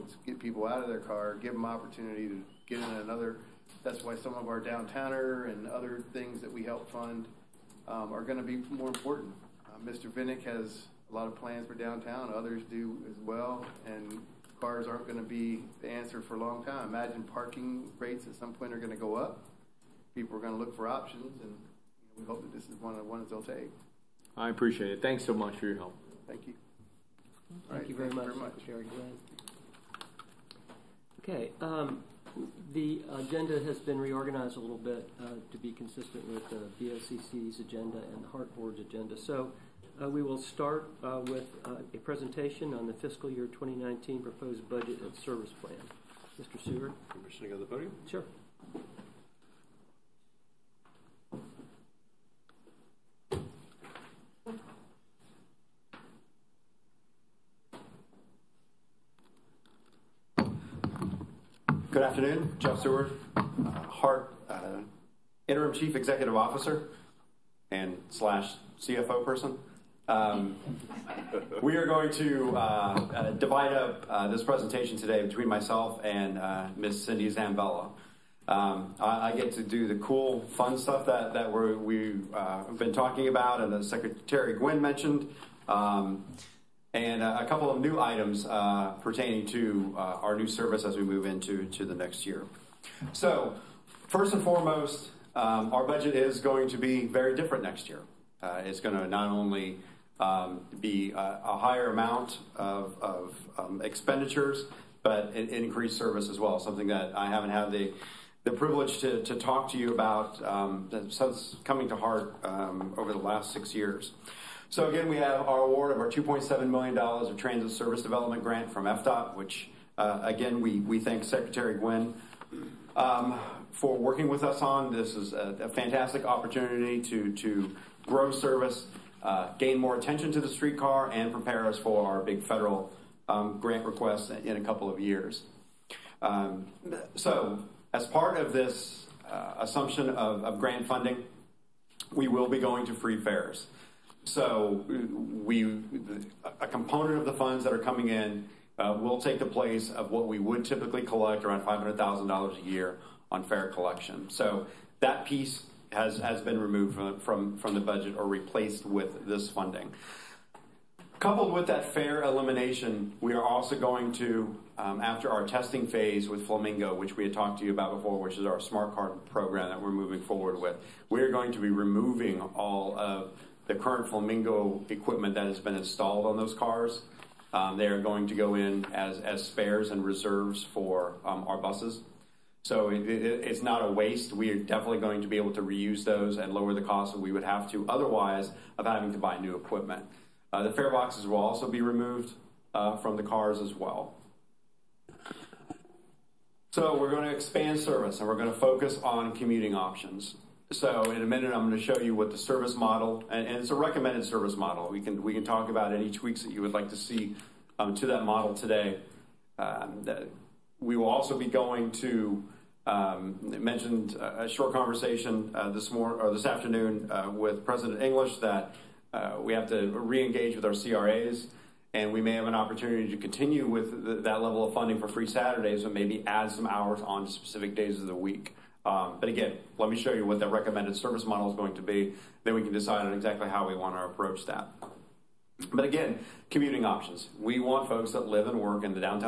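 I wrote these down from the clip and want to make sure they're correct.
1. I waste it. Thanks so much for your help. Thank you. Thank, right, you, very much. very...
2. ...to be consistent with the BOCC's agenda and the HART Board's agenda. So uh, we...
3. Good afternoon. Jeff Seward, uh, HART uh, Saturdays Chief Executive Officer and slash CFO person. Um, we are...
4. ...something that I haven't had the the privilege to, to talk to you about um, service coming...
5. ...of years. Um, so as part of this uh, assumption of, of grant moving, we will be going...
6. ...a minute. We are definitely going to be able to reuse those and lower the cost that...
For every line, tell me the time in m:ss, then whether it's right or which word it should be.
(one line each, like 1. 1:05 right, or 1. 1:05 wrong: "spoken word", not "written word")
1. 0:24 wrong: "appreciate", not "waste"
2. 0:35 right
3. 1:01 wrong: "Interim", not "Saturdays"
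4. 1:46 wrong: "since", not "service"
5. 2:14 wrong: "funding", not "moving"
6. 3:03 wrong: "waste", not "minute".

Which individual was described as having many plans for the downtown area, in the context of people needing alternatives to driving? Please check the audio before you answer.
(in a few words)
Mr. Vinik.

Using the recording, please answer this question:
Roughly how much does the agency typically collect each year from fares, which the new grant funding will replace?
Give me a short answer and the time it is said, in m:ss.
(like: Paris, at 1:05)
$500,000, at 2:31.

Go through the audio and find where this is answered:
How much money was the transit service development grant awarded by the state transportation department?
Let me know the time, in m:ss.
1:56.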